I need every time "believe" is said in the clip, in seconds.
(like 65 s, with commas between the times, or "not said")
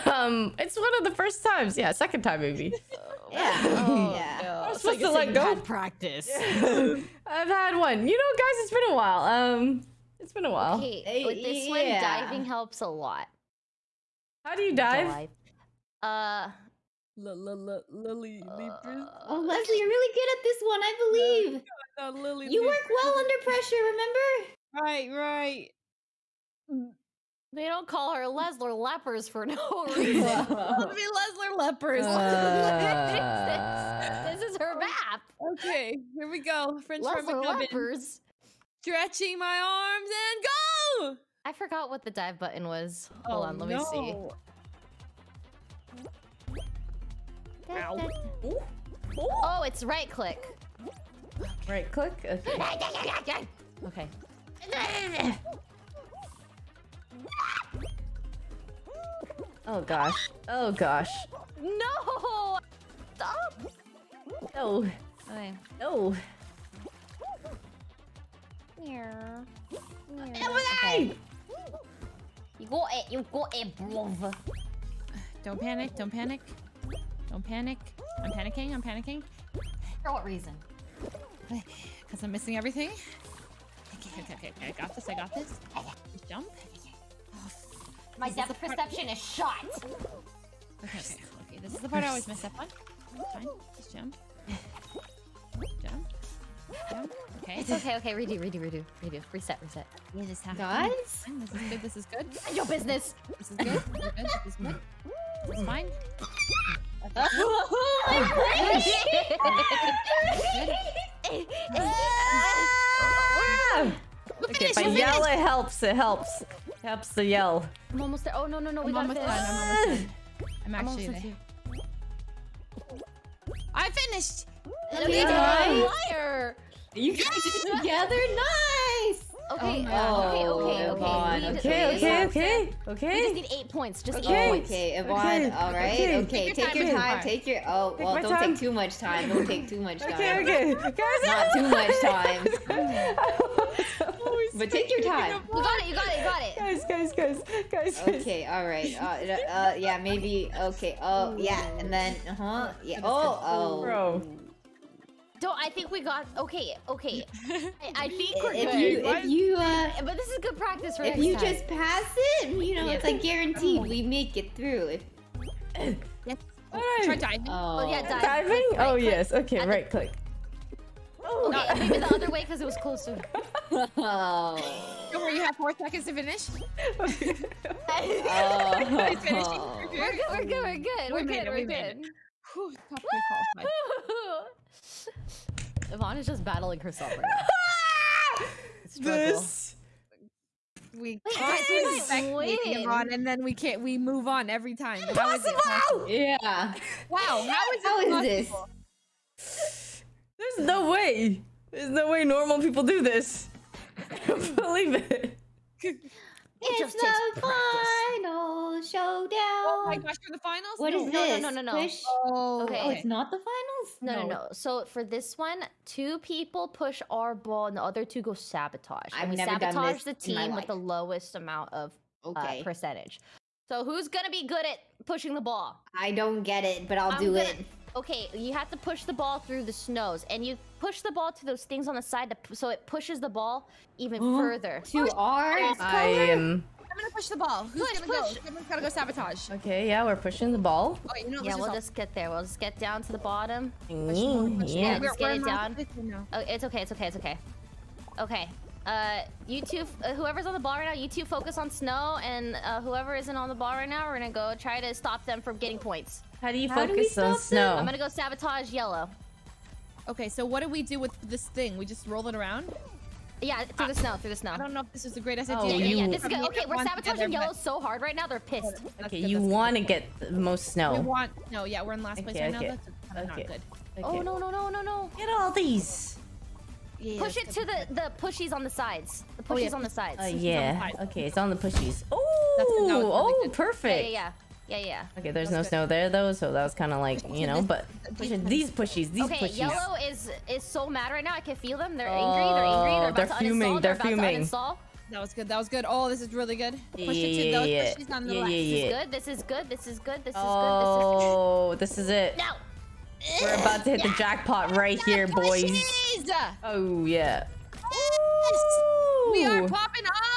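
20 s, 204 s.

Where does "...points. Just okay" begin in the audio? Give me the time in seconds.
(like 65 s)
133 s.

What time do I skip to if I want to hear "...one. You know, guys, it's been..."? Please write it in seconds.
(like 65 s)
7 s.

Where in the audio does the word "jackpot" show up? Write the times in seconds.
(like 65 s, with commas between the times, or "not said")
304 s.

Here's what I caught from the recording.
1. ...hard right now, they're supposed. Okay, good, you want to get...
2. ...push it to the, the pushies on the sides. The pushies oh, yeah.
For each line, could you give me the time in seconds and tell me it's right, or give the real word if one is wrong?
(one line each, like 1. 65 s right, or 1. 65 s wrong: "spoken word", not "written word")
1. 267 s wrong: "pissed", not "supposed"
2. 277 s right.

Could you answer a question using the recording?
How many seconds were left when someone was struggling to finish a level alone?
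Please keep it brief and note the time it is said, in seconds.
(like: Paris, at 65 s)
4, at 175 s.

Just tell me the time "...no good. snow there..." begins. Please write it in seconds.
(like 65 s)
285 s.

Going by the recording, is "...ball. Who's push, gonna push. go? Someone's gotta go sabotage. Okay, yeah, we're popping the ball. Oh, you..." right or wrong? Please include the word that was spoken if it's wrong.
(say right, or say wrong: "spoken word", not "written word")
wrong: "pushing", not "popping".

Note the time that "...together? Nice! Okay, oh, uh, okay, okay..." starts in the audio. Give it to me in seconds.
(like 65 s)
127 s.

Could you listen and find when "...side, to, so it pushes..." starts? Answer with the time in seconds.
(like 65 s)
232 s.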